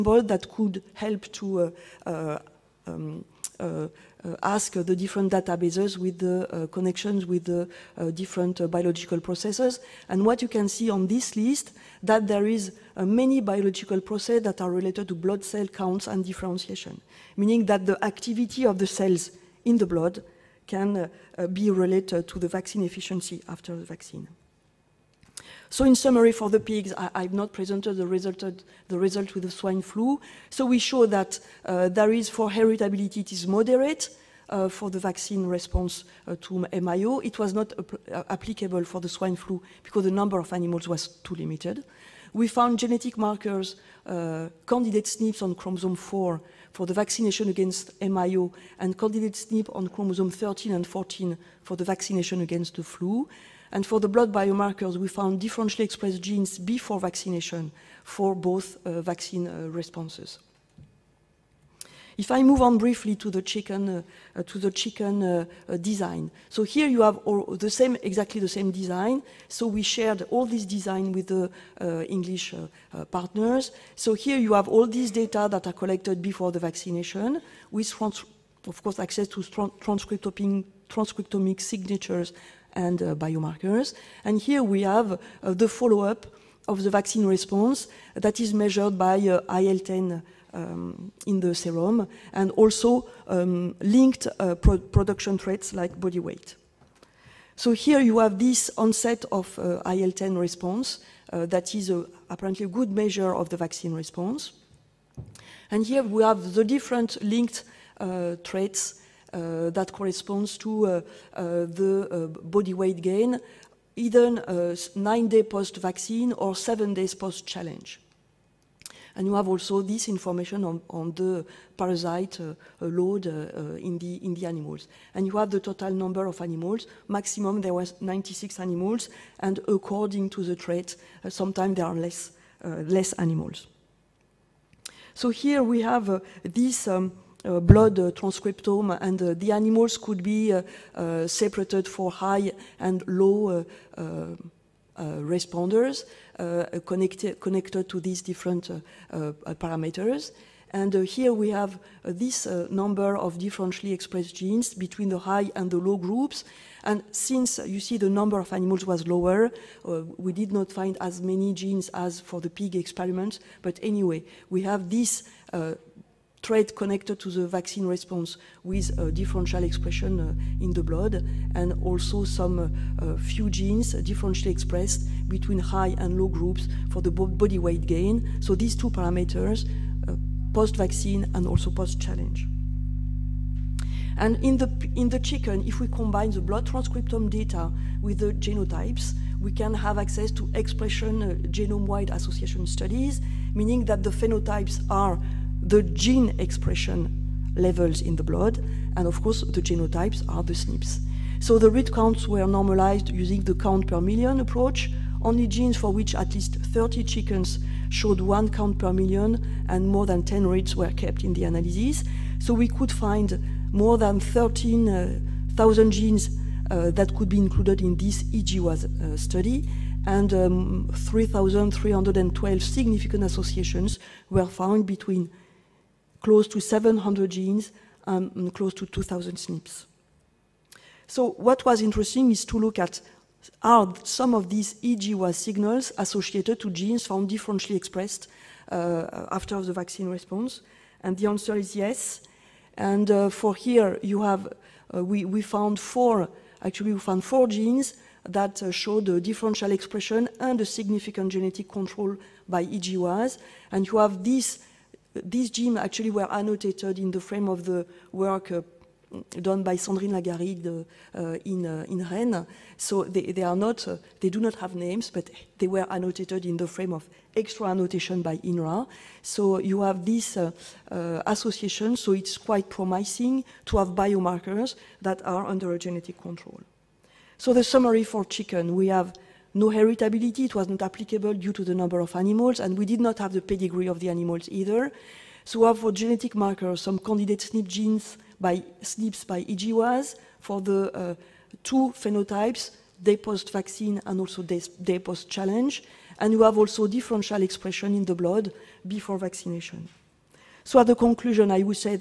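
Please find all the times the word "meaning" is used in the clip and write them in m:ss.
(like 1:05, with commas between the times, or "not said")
0:17, 3:13.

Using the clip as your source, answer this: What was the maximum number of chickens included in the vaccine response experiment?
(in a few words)
96.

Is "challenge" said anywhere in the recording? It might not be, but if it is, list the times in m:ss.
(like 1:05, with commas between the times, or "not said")
1:57, 3:01, 4:55.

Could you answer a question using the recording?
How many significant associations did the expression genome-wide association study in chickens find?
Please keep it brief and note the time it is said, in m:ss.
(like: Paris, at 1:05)
3,312, at 3:40.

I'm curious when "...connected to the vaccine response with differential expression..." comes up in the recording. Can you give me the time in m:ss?
2:46.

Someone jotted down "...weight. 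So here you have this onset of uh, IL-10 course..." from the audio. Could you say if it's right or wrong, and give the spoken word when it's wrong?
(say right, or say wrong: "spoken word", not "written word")
wrong: "response", not "course".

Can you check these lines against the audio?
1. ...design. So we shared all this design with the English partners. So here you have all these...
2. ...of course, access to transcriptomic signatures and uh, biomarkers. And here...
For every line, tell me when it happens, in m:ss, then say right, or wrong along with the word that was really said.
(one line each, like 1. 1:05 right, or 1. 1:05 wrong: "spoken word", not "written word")
1. 1:08 right
2. 1:18 right.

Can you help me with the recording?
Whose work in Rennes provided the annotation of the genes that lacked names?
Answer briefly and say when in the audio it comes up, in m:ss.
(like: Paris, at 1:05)
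Sandrine Lagarrigue, at 4:19.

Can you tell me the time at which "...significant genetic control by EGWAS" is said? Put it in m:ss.
4:10.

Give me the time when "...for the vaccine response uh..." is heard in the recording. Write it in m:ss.
0:34.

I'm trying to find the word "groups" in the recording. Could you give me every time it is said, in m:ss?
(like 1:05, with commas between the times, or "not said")
2:35, 2:56.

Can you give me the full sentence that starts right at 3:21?
So the read counts were normalized using the count per million approach.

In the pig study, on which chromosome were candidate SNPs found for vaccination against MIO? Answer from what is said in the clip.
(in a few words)
Chromosome 4.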